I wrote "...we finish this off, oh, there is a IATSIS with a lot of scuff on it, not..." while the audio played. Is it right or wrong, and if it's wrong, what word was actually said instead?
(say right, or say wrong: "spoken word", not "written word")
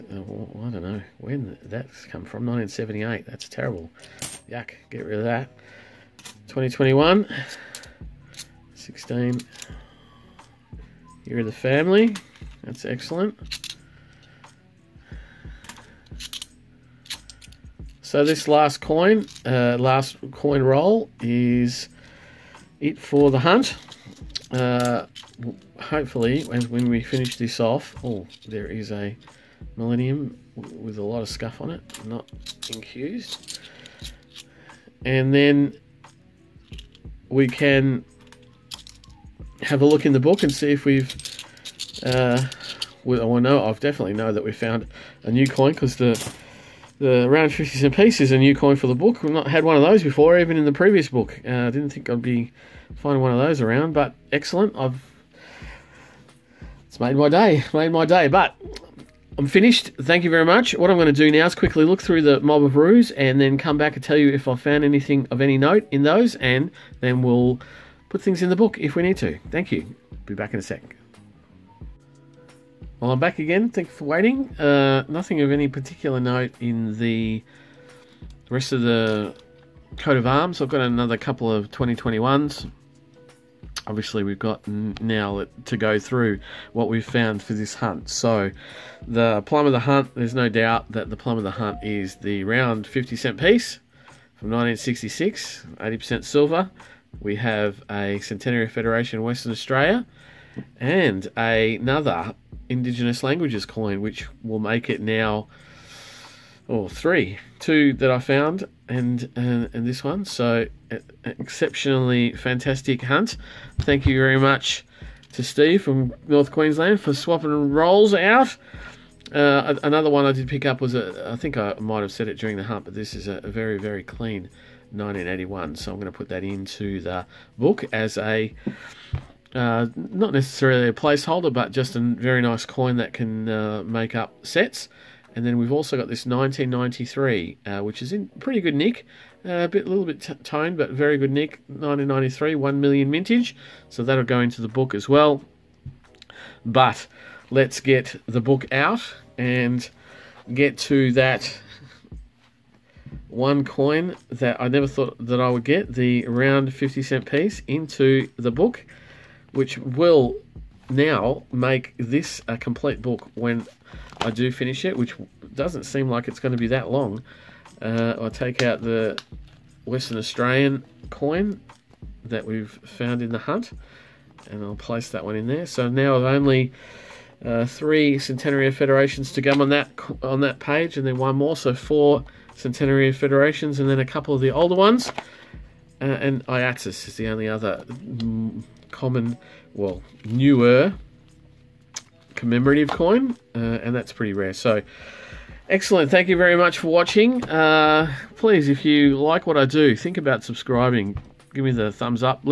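wrong: "Millennium", not "IATSIS".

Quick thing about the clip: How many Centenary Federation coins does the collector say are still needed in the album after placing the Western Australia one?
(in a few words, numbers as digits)
4.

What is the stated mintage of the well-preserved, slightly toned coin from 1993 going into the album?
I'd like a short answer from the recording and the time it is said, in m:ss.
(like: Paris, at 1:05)
1 million, at 2:22.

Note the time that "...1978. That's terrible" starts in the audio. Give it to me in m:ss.
0:02.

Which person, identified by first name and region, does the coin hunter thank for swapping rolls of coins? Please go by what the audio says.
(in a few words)
Steve from North Queensland.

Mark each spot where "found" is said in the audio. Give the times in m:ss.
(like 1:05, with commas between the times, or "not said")
0:44, 1:04, 1:27, 1:48, 2:52.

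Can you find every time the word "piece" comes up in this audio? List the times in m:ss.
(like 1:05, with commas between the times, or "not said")
0:47, 1:33, 2:37.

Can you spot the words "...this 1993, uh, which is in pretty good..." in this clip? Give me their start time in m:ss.
2:16.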